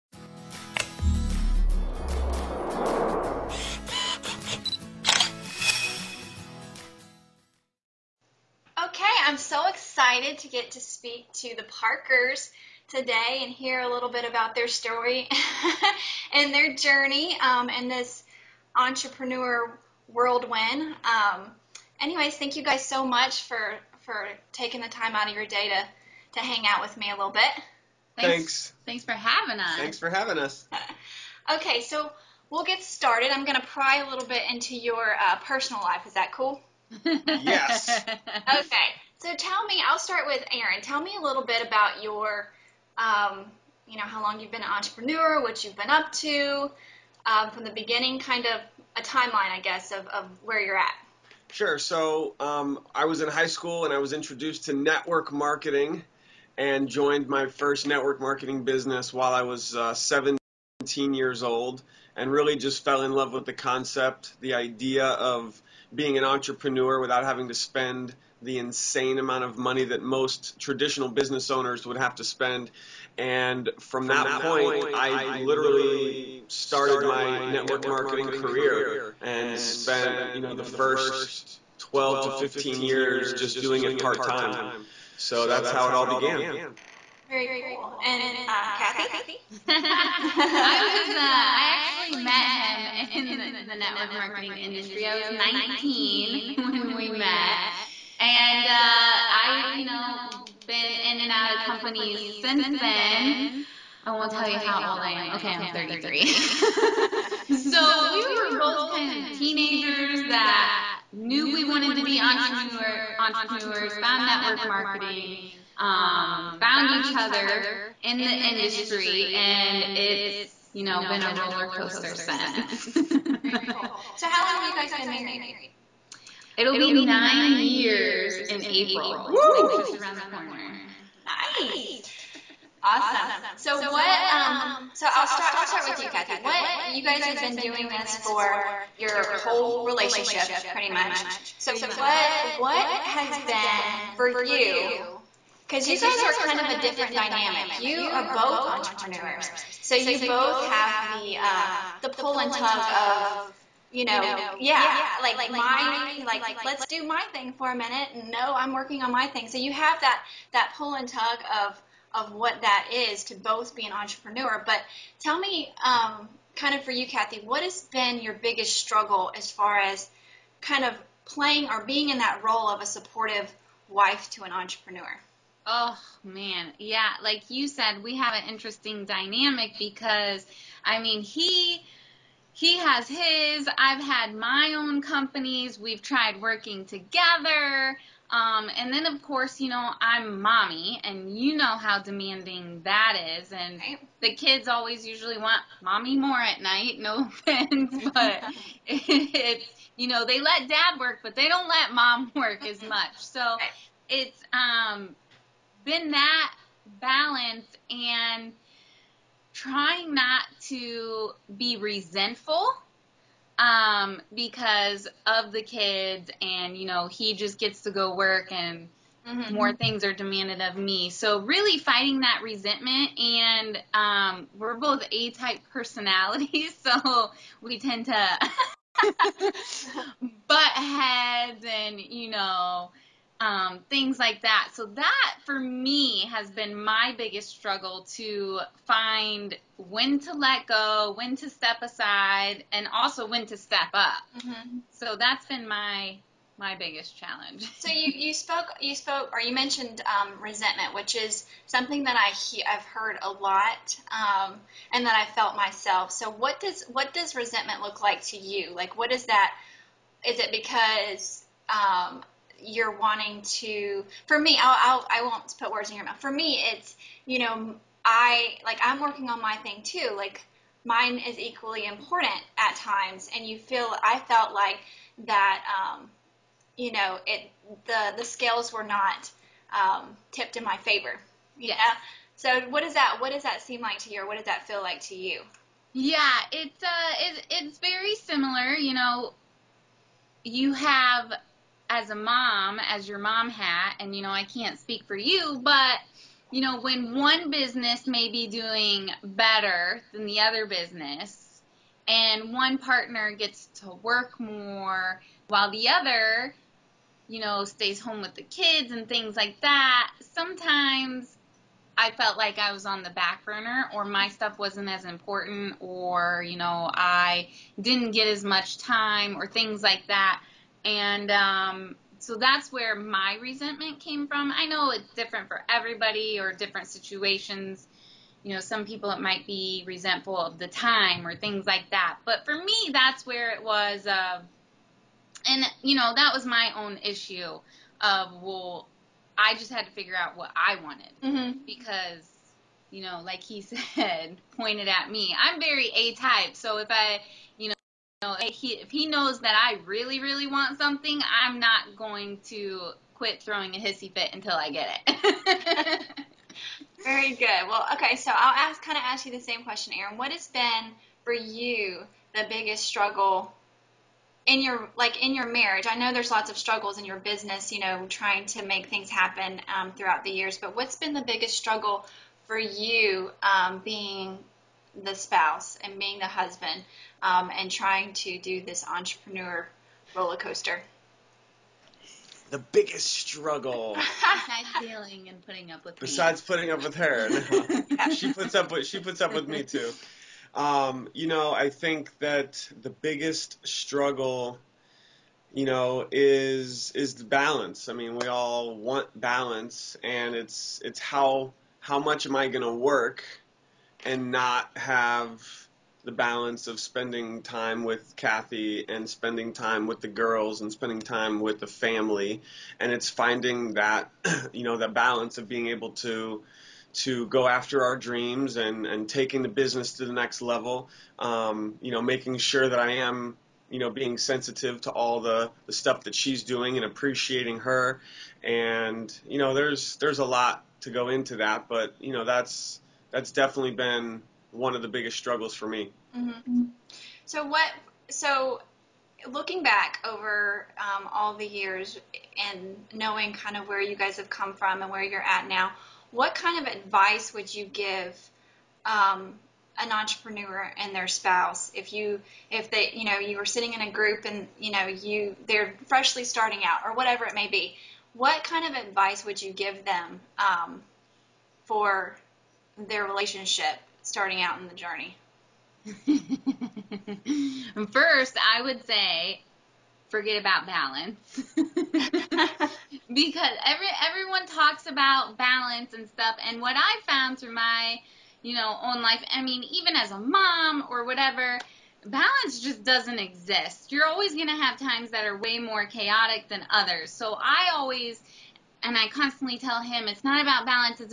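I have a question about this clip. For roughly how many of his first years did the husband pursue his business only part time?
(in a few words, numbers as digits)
12 to 15.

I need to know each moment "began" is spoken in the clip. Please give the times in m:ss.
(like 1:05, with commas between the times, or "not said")
1:26.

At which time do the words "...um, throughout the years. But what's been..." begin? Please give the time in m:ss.
6:09.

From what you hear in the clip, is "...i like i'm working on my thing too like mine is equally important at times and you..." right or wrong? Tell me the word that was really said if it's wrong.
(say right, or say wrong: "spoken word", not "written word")
right.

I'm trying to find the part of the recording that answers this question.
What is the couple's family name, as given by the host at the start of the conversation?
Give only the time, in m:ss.
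0:11.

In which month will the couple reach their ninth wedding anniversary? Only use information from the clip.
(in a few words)
April.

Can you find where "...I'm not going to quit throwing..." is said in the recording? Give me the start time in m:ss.
5:51.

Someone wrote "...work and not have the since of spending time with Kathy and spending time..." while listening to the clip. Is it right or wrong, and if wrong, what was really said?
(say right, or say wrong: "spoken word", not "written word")
wrong: "balance", not "since".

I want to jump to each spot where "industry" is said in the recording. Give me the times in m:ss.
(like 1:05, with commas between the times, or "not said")
1:34, 1:58.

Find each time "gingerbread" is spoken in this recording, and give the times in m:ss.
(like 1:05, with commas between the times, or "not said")
not said.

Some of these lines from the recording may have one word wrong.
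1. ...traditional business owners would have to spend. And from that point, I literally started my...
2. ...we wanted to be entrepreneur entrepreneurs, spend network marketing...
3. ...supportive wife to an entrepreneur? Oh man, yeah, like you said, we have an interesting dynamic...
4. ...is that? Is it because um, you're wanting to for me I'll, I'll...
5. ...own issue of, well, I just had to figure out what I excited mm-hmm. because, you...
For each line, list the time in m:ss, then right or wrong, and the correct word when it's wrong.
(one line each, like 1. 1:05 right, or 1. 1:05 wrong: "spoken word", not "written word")
1. 1:10 right
2. 1:51 wrong: "found", not "spend"
3. 2:52 right
4. 4:19 right
5. 5:36 wrong: "wanted", not "excited".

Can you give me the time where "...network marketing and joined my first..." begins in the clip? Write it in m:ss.
0:54.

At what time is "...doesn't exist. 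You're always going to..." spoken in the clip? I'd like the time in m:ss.
8:02.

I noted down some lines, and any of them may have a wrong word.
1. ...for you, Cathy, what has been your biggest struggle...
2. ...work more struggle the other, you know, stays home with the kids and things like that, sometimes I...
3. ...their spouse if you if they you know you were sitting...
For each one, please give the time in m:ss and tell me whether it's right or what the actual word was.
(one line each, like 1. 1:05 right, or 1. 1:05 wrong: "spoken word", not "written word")
1. 2:46 right
2. 5:04 wrong: "while", not "struggle"
3. 7:30 right.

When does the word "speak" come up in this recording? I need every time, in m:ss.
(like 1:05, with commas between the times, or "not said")
0:10, 4:54.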